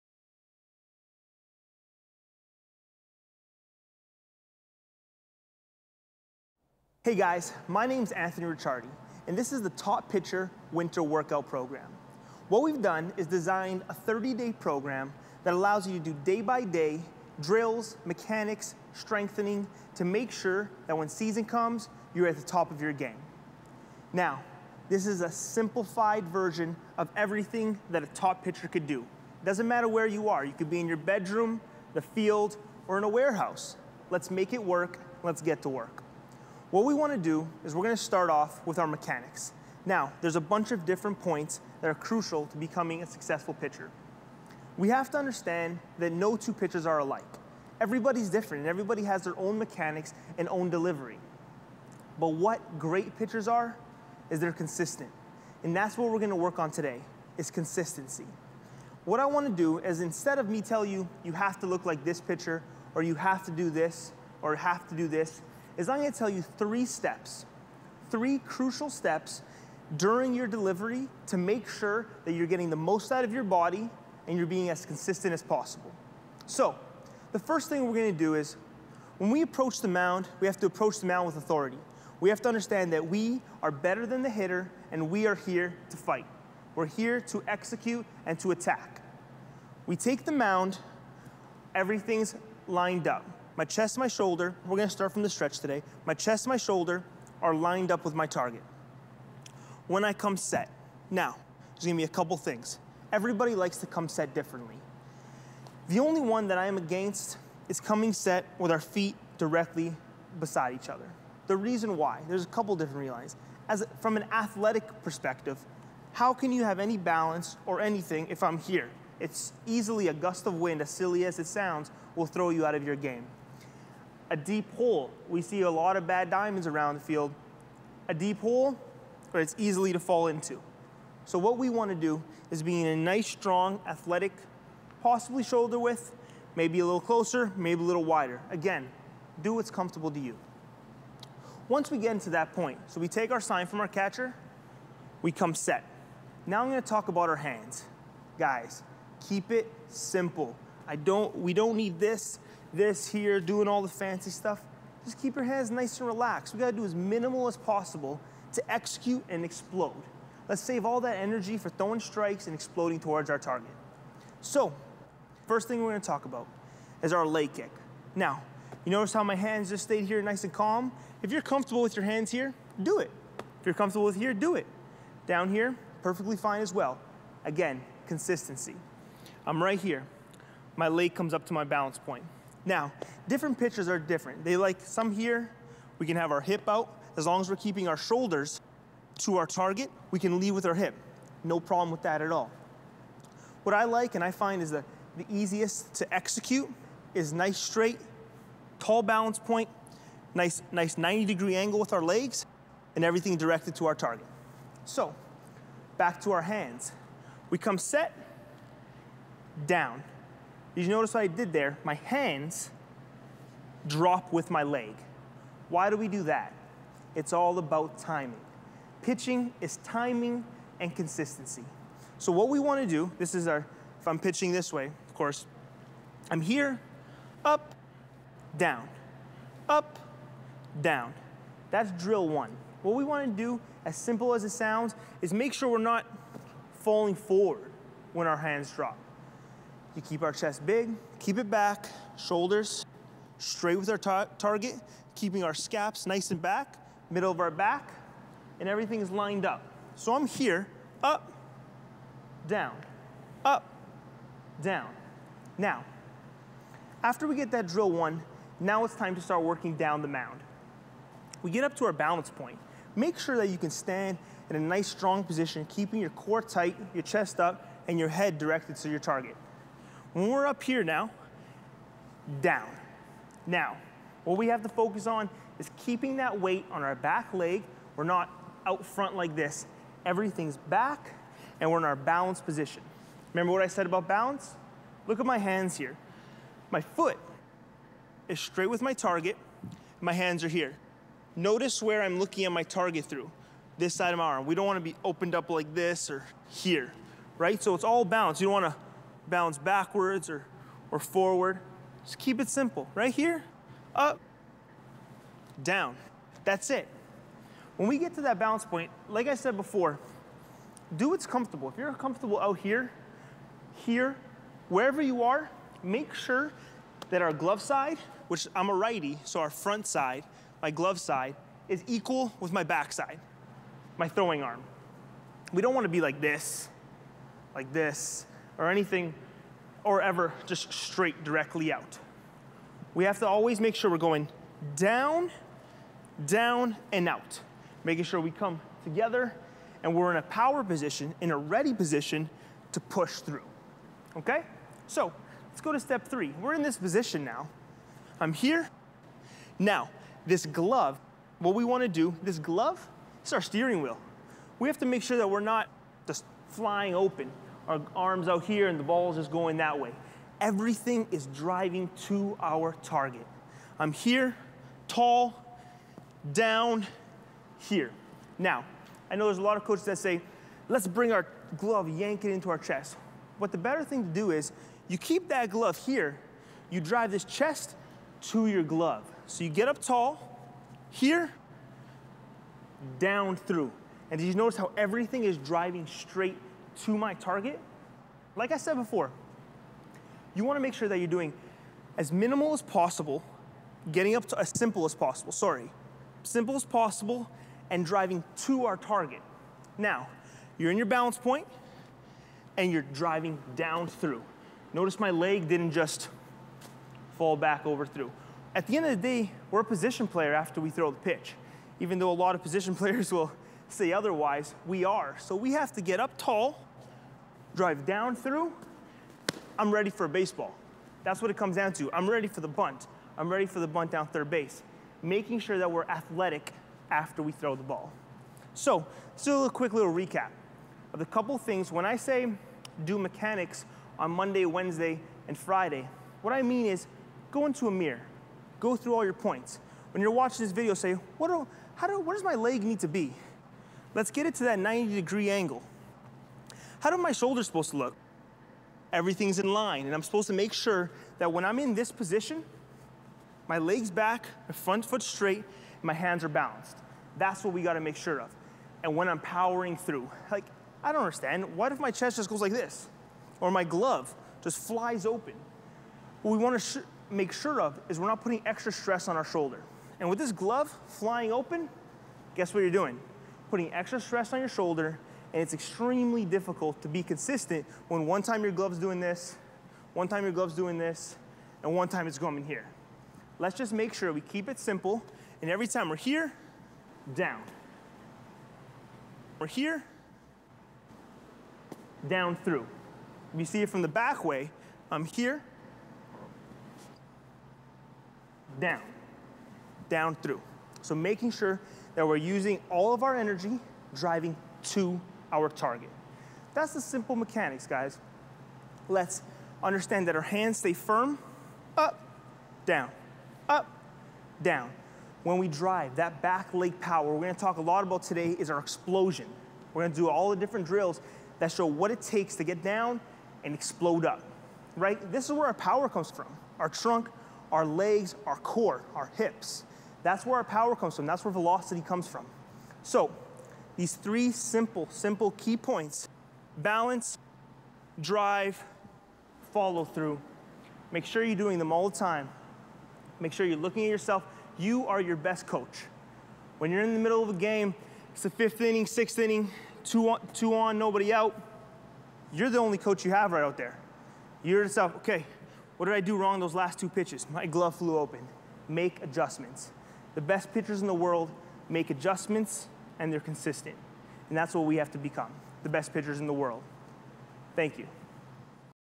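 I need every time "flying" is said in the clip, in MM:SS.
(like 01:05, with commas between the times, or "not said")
05:56, 07:50.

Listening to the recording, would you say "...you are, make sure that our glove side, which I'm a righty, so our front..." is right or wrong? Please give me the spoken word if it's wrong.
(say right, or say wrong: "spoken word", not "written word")
right.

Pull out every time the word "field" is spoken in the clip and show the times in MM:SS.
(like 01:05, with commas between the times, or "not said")
00:32, 02:07.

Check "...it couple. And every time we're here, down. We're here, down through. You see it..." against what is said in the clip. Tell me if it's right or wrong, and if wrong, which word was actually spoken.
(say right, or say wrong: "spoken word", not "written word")
wrong: "simple", not "couple".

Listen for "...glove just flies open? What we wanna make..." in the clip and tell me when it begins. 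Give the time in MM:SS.
07:43.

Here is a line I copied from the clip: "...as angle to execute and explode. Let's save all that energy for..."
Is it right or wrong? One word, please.
wrong.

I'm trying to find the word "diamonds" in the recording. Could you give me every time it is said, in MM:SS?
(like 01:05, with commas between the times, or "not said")
02:06.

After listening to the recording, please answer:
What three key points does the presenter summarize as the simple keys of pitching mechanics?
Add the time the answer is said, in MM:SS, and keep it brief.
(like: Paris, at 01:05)
balance, drive, follow through, at 08:56.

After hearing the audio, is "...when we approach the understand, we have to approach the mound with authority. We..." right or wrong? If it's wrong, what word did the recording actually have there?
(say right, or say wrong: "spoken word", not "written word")
wrong: "mound", not "understand".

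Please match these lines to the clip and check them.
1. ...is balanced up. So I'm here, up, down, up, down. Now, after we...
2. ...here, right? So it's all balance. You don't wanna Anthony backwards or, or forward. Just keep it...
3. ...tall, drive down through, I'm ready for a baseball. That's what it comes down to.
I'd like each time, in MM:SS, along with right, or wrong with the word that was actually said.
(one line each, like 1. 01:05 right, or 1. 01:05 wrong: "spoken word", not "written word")
1. 04:09 wrong: "lined", not "balanced"
2. 04:56 wrong: "Balance", not "Anthony"
3. 06:56 right.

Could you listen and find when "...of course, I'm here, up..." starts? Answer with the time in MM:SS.
03:45.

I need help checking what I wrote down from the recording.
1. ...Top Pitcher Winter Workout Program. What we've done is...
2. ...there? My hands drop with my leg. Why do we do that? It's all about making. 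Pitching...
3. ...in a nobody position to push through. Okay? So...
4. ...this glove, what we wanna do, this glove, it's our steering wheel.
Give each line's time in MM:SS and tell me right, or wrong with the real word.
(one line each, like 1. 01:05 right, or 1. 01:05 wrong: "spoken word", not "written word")
1. 00:09 right
2. 03:31 wrong: "timing", not "making"
3. 05:41 wrong: "ready", not "nobody"
4. 05:50 right.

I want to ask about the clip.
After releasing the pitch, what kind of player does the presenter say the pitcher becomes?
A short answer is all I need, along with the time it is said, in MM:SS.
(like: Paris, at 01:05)
position player, at 06:49.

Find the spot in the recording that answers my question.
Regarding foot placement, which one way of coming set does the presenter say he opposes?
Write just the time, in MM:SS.
01:48.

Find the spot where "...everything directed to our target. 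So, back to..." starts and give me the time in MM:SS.
03:23.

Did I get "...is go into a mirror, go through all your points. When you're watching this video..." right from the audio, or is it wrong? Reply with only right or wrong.
right.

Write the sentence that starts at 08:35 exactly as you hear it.
When we drive, that back leg power we're gonna talk a lot about today is our explosion.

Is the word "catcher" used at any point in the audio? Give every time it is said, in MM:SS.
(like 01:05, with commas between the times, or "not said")
02:23.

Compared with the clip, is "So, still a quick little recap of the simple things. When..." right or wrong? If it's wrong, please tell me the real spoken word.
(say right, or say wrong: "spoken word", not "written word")
wrong: "couple", not "simple".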